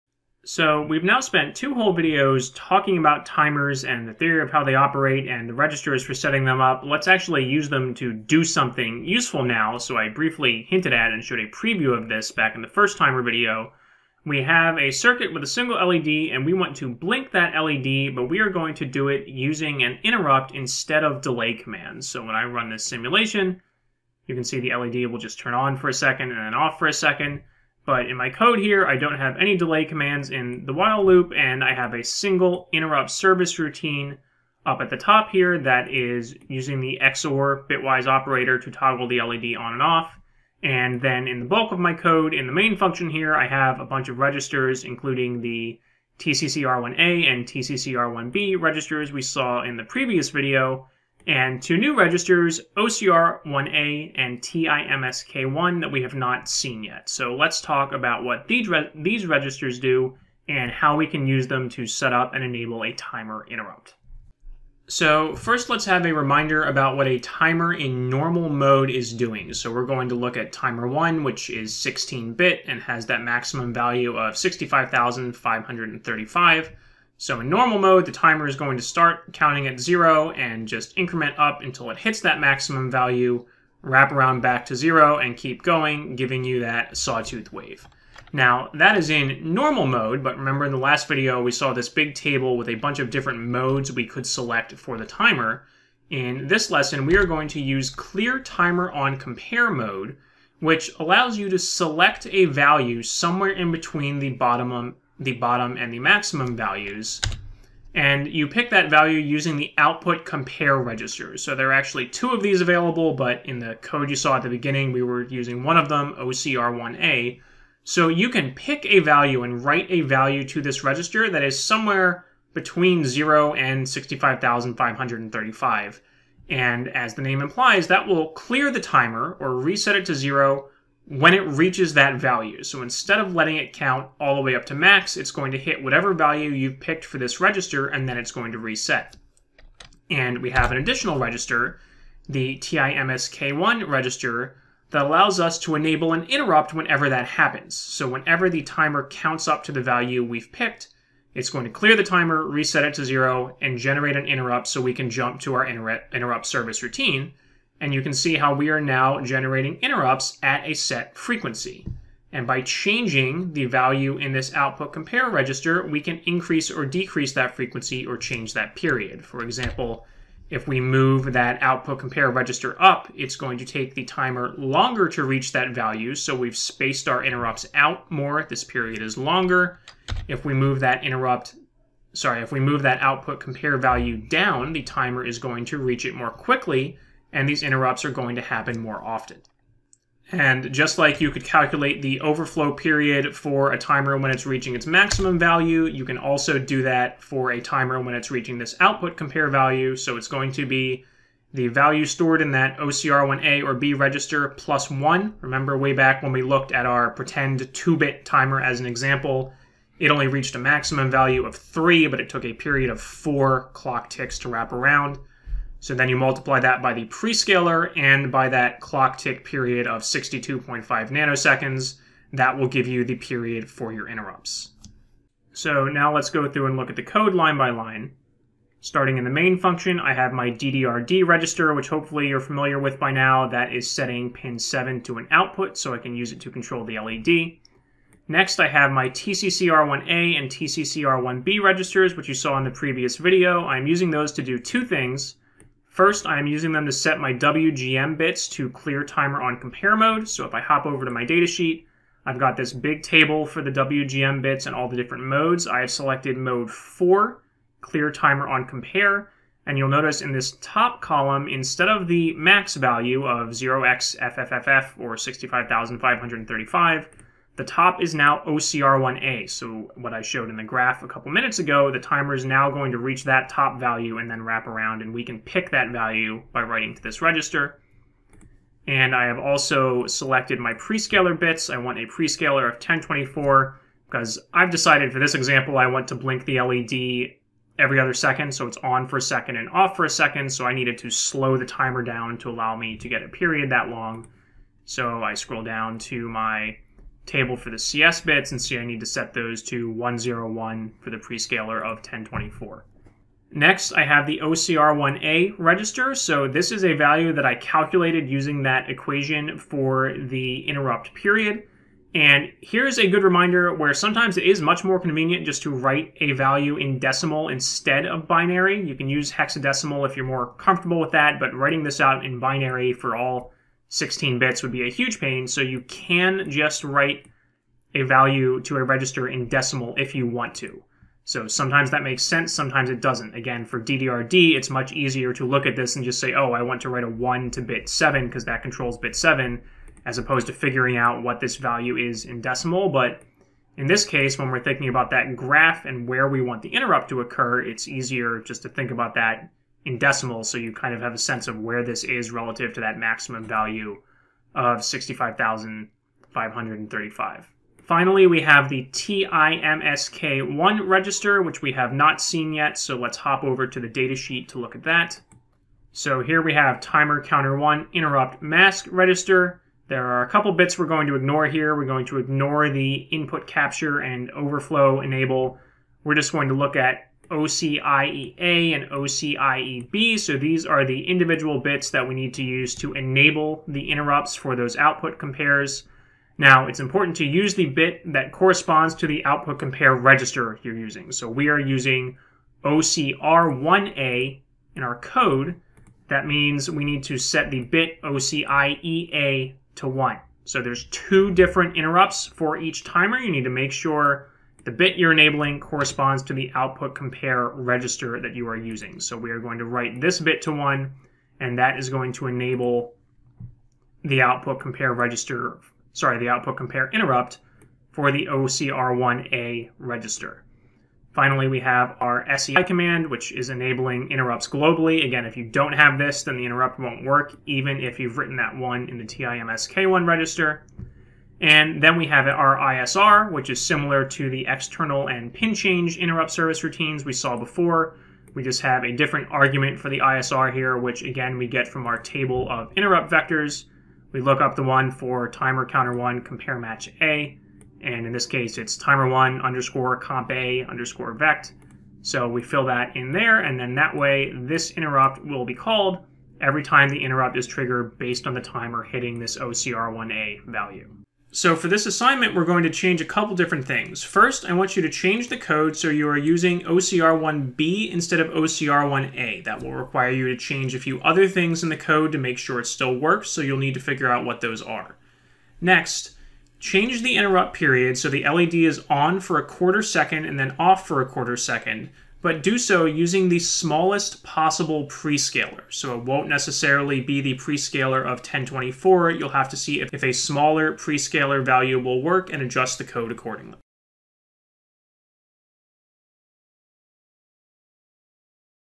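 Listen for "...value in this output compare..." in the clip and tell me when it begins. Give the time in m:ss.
2:43.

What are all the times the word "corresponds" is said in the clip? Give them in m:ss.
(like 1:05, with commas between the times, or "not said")
6:28, 6:45.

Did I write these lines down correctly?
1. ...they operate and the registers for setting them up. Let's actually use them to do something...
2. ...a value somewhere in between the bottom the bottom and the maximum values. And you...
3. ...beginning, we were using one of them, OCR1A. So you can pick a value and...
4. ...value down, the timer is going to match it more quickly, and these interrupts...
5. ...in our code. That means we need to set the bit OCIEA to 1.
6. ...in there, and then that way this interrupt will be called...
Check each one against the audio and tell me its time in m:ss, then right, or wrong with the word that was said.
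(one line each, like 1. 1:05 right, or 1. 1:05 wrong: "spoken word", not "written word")
1. 0:04 right
2. 1:42 right
3. 1:54 right
4. 3:03 wrong: "reach", not "match"
5. 6:34 right
6. 7:32 right.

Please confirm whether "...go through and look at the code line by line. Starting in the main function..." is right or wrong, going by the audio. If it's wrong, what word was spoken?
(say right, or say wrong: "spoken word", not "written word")
right.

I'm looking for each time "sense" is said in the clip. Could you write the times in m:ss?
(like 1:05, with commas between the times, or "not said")
5:32, 5:51.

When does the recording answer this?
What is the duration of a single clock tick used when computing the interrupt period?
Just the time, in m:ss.
3:40.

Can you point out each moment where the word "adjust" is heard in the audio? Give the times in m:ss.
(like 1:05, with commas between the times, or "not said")
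8:12.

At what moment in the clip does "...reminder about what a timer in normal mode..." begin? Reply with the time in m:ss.
1:06.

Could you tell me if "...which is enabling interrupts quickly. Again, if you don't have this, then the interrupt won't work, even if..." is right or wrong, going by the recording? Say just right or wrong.
wrong.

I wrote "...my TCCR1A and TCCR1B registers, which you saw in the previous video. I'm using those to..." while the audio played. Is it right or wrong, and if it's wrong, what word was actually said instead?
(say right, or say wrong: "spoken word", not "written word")
right.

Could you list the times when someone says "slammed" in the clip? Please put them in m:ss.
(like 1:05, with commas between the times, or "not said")
not said.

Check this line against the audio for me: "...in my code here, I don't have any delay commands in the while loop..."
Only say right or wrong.
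right.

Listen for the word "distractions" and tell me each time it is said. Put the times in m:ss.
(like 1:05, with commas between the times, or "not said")
not said.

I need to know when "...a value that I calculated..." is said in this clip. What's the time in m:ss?
5:06.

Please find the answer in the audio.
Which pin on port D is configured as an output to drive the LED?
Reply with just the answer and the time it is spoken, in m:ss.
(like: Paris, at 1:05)
Pin 7, at 3:54.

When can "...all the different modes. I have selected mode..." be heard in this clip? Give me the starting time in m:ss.
4:14.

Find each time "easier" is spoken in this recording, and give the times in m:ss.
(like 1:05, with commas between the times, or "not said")
5:34, 5:47.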